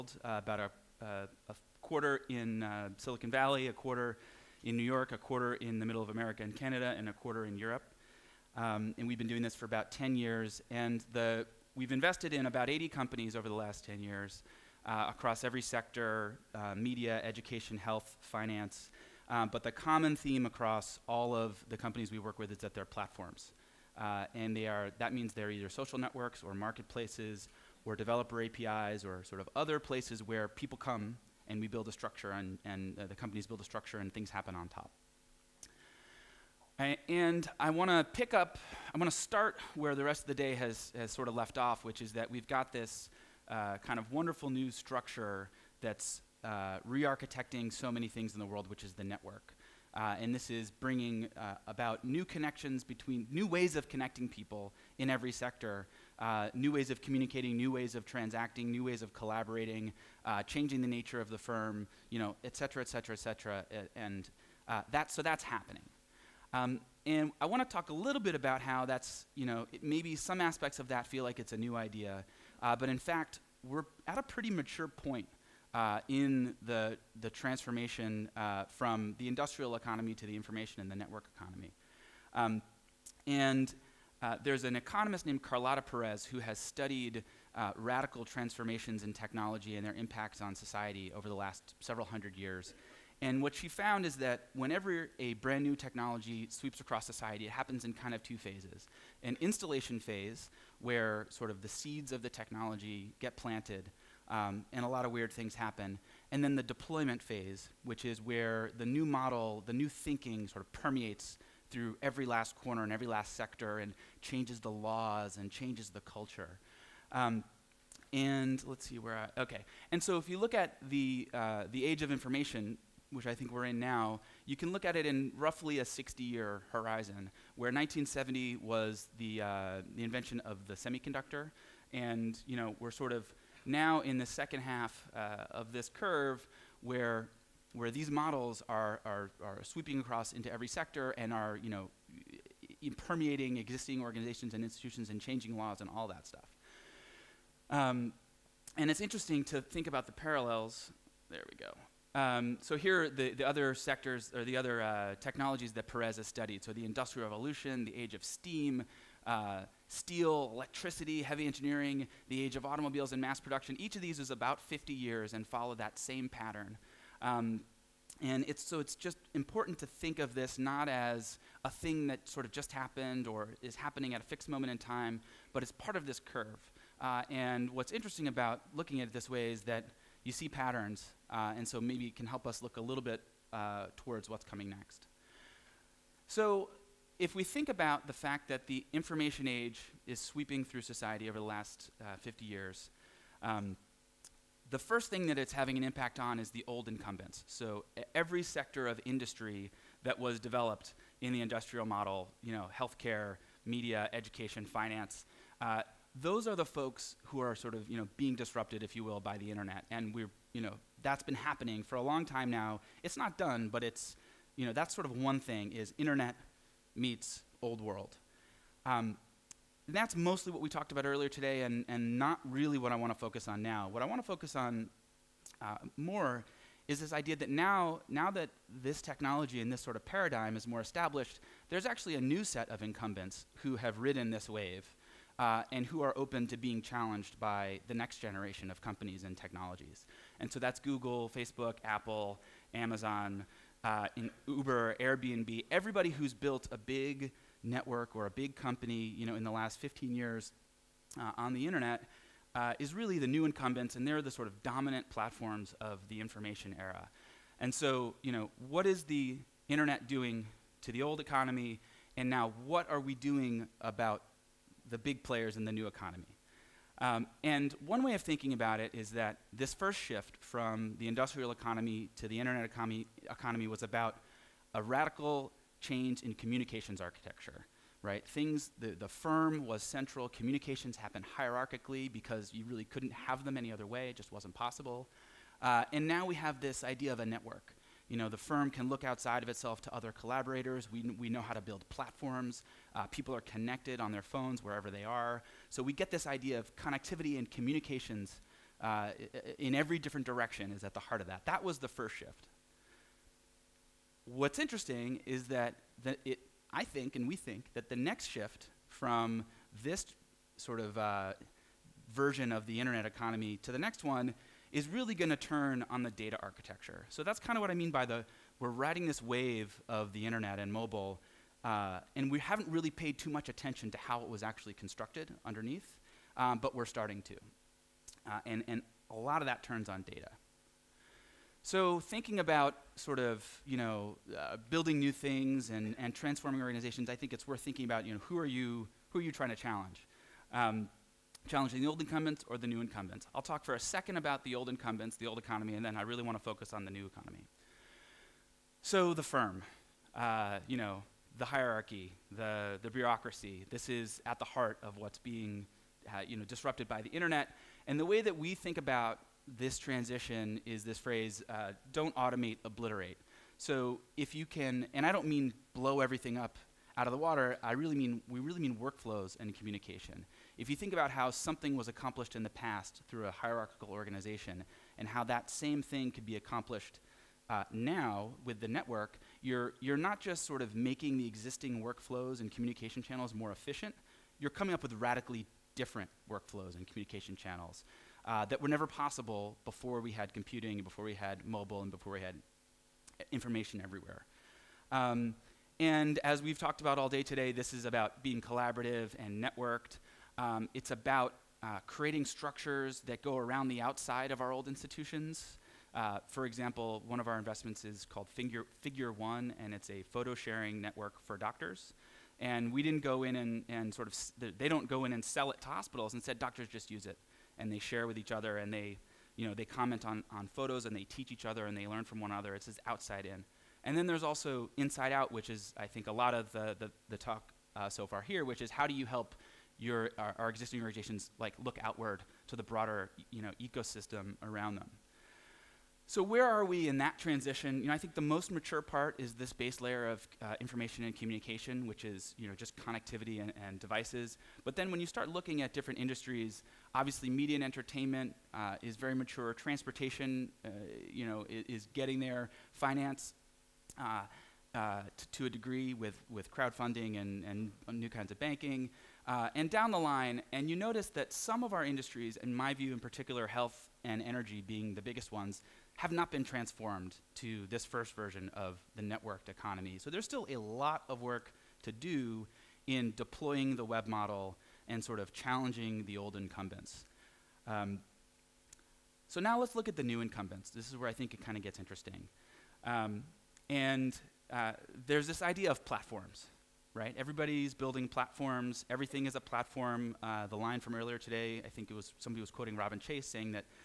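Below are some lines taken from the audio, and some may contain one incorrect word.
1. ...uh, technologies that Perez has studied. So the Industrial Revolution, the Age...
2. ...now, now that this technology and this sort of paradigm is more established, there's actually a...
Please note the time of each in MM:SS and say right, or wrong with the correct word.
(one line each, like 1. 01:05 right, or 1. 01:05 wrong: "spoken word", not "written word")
1. 02:34 right
2. 03:47 right.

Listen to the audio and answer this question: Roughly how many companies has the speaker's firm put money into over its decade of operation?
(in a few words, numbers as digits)
80.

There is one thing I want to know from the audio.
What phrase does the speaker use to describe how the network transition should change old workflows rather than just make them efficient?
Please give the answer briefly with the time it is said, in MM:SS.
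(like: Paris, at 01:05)
Don't automate, obliterate, at 06:01.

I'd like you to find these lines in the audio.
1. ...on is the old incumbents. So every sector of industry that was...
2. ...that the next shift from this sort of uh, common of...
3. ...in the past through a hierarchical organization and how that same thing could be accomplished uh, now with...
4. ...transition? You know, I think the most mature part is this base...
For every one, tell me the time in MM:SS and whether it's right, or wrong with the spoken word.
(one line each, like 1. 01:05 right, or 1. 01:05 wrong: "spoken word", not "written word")
1. 03:16 right
2. 05:07 wrong: "version", not "common"
3. 06:12 right
4. 07:17 right.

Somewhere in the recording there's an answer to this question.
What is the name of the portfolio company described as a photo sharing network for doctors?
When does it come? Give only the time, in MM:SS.
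06:48.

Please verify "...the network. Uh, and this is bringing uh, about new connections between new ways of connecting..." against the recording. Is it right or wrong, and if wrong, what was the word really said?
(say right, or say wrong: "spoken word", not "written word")
right.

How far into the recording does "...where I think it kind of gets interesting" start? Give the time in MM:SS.
08:00.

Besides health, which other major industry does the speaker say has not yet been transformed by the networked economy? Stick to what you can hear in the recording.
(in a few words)
Energy.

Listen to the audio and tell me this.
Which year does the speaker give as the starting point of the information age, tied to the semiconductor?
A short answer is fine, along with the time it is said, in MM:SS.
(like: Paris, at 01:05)
1970, at 02:07.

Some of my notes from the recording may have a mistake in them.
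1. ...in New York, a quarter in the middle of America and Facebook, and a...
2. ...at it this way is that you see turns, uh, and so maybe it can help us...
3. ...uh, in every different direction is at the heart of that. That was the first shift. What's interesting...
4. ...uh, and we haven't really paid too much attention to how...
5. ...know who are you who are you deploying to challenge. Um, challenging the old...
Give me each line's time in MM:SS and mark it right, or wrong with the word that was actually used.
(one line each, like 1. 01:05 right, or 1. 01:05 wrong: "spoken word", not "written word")
1. 00:04 wrong: "Canada", not "Facebook"
2. 02:59 wrong: "patterns", not "turns"
3. 04:58 right
4. 05:21 right
5. 05:38 wrong: "trying", not "deploying".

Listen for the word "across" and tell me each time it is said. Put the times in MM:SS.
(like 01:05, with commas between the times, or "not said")
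00:15, 00:20, 01:36, 02:19.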